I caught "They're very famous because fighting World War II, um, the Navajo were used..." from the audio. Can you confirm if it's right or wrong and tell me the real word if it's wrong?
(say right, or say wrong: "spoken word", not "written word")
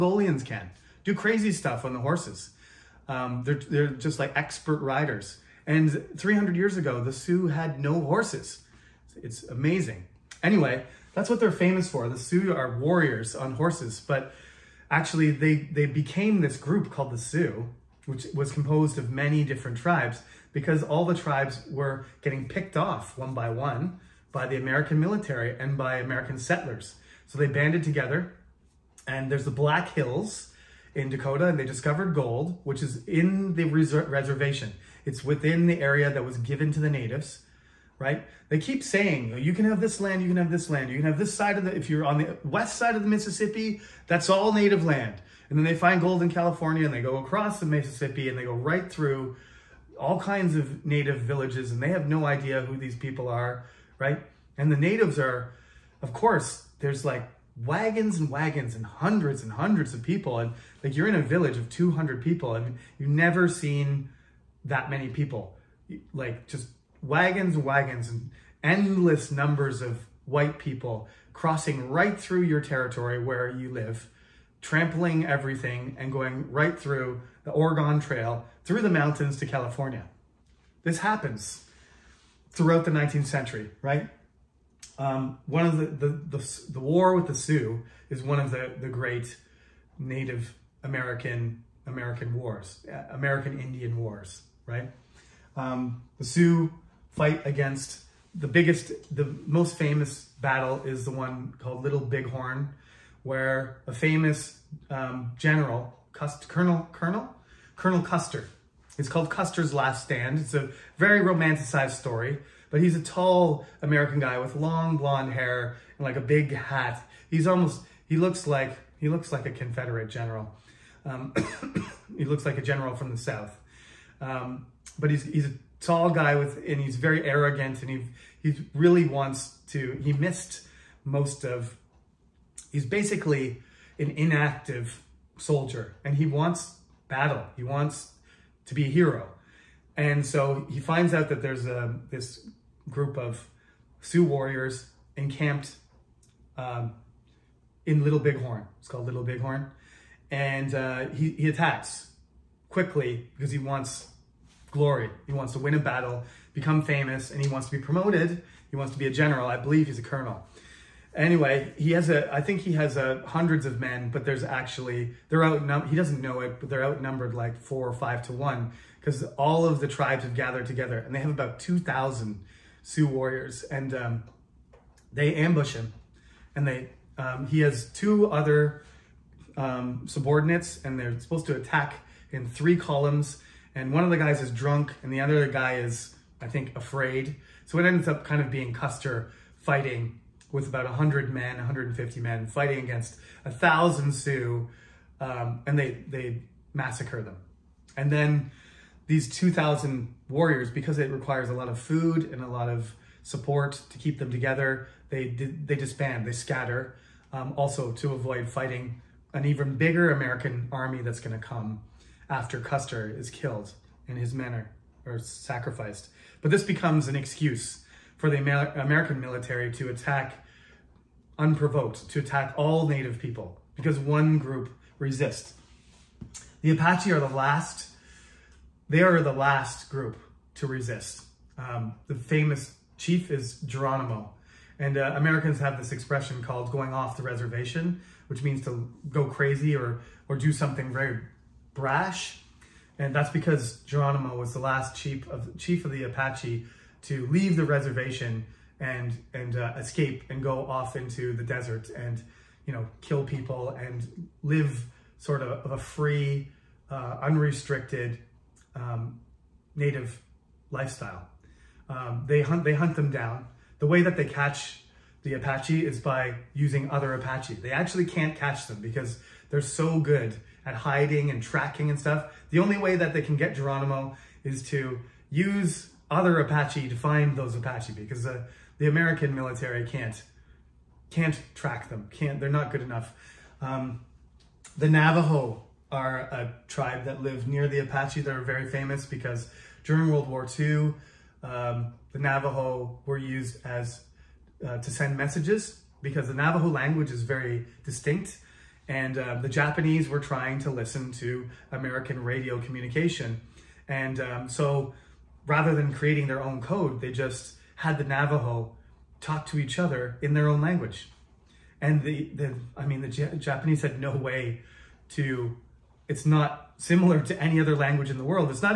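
wrong: "during", not "fighting".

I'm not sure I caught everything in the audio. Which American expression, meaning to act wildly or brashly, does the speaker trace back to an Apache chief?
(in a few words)
going off the reservation.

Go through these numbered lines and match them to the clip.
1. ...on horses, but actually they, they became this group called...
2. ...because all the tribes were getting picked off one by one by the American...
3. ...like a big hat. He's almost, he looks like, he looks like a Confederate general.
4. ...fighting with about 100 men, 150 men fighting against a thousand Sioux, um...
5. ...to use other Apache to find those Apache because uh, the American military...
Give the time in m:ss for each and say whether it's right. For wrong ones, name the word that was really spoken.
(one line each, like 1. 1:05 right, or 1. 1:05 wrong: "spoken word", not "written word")
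1. 0:13 right
2. 0:20 right
3. 1:56 right
4. 3:09 right
5. 4:34 right.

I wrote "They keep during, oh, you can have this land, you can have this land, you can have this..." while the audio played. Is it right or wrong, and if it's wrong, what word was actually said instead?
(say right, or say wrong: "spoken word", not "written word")
wrong: "saying", not "during".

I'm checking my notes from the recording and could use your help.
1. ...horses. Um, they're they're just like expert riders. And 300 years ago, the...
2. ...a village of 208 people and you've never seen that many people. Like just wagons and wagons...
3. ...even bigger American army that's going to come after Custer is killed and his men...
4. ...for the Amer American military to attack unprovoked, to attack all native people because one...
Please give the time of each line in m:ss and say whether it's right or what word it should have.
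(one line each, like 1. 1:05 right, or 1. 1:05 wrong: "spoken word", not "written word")
1. 0:01 right
2. 1:01 wrong: "200", not "208"
3. 3:29 right
4. 3:38 right.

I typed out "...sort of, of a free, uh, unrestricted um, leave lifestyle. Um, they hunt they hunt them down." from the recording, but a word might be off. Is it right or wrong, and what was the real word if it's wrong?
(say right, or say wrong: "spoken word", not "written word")
wrong: "native", not "leave".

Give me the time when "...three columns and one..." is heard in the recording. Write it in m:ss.
3:02.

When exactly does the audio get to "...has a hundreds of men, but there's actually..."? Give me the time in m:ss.
2:42.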